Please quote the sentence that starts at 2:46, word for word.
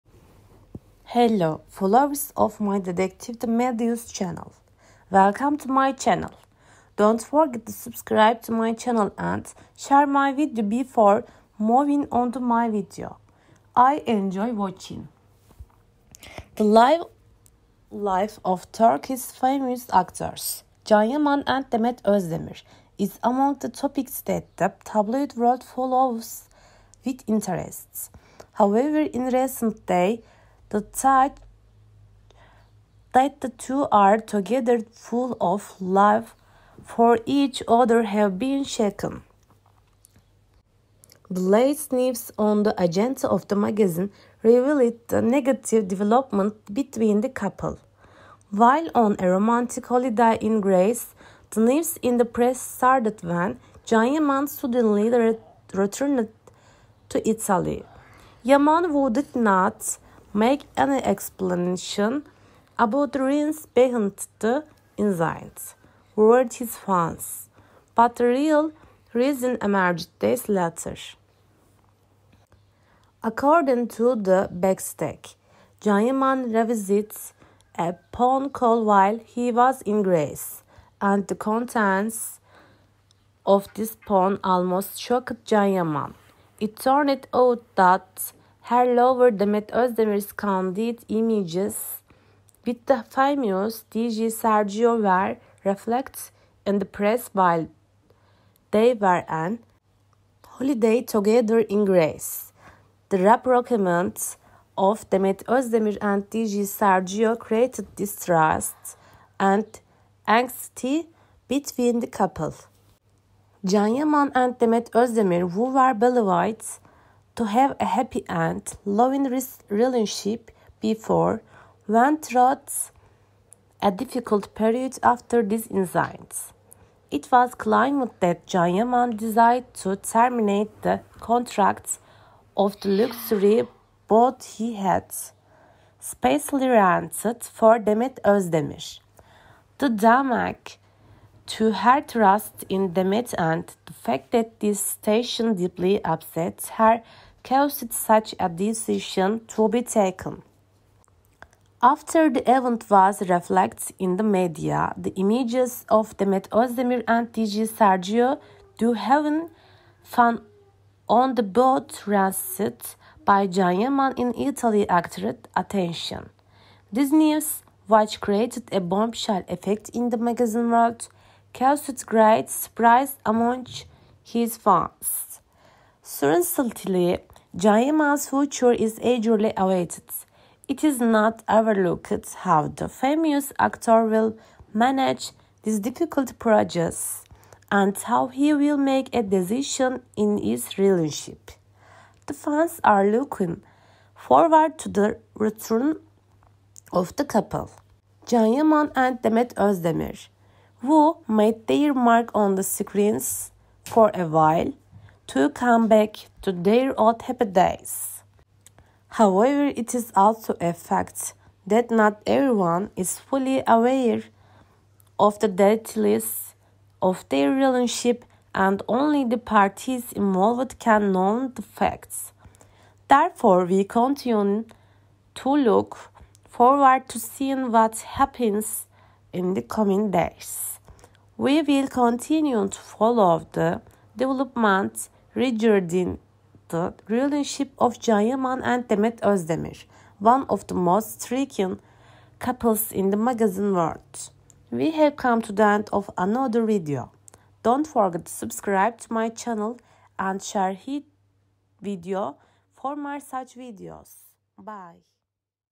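This news, which created a bombshell effect in the magazine world, caused great surprise among his fans.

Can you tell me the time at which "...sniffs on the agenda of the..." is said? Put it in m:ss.
0:41.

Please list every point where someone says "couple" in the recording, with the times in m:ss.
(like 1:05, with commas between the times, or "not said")
0:47, 1:52, 3:17, 4:02.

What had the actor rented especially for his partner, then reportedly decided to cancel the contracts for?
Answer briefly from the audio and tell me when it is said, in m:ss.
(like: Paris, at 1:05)
luxury boat, at 2:12.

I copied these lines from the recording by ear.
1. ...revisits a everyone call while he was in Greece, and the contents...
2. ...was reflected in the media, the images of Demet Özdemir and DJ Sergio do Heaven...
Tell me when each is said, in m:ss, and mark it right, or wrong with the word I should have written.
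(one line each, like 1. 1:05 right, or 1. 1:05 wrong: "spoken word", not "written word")
1. 1:16 wrong: "phone", not "everyone"
2. 2:32 right.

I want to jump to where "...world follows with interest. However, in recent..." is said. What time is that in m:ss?
0:25.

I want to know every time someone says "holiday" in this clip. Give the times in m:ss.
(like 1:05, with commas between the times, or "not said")
0:49, 1:40.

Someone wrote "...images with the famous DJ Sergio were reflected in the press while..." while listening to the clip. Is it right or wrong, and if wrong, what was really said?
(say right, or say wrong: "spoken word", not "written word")
right.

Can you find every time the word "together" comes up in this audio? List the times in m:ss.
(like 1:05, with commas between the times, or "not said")
0:34, 1:41.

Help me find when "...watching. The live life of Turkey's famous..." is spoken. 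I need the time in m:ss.
0:14.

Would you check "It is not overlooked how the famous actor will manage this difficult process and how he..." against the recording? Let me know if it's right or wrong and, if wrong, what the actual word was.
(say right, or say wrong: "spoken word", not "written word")
right.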